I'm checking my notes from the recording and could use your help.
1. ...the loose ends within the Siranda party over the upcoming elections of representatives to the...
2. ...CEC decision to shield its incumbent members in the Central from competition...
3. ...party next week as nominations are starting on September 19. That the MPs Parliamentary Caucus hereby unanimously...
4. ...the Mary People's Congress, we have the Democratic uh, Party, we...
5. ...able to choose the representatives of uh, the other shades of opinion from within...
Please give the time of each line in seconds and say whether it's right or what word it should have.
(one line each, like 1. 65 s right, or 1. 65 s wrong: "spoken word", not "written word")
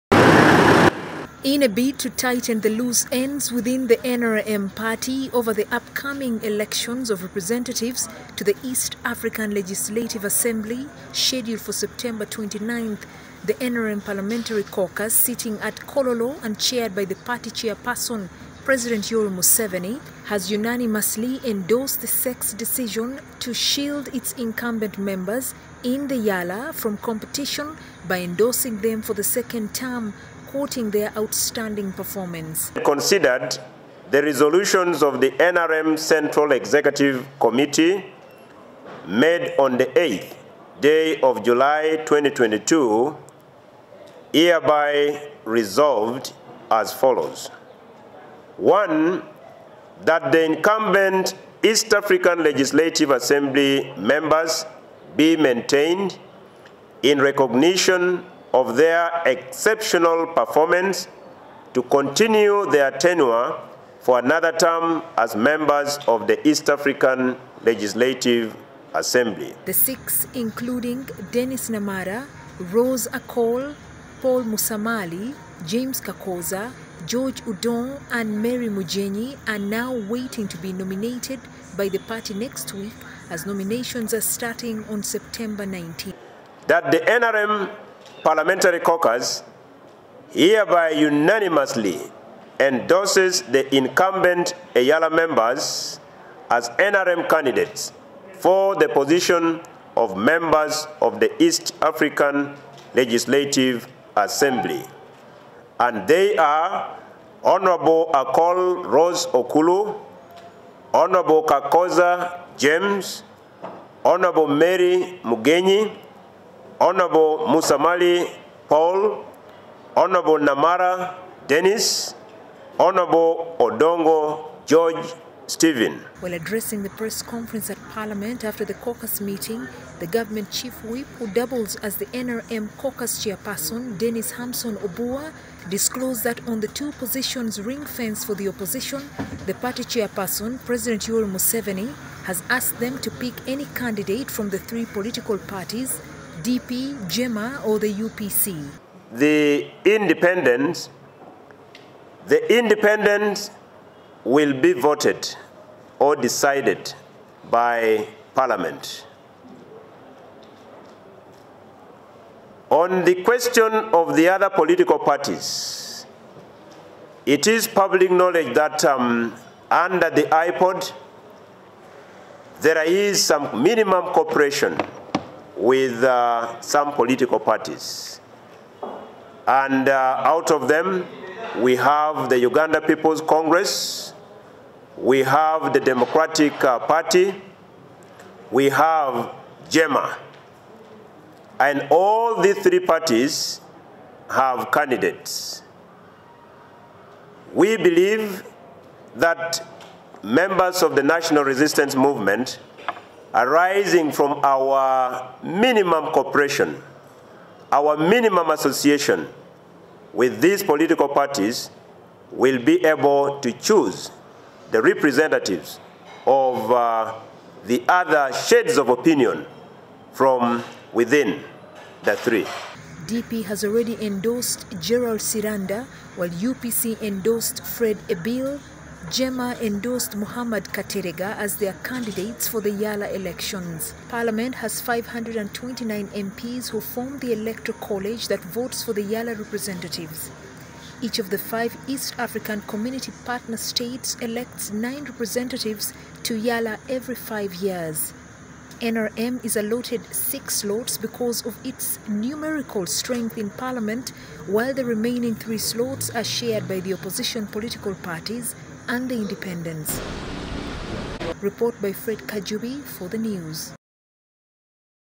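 1. 2 s wrong: "NRM", not "Siranda"
2. 22 s wrong: "EALA", not "Central"
3. 81 s wrong: "NRM", not "MPs"
4. 182 s wrong: "Uganda", not "Mary"
5. 212 s right.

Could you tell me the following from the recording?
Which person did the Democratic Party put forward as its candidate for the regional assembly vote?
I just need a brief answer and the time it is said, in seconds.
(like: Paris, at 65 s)
Gerald Siranda, at 224 s.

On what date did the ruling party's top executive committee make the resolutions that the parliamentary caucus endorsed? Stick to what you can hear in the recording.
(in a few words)
8th day of July 2022.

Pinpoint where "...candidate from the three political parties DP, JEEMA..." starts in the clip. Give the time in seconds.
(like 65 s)
143 s.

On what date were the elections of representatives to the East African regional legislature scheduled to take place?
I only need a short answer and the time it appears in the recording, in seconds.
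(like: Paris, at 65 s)
September 29th, at 11 s.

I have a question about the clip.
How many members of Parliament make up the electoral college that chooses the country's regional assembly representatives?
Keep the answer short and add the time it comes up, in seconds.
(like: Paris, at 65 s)
529, at 234 s.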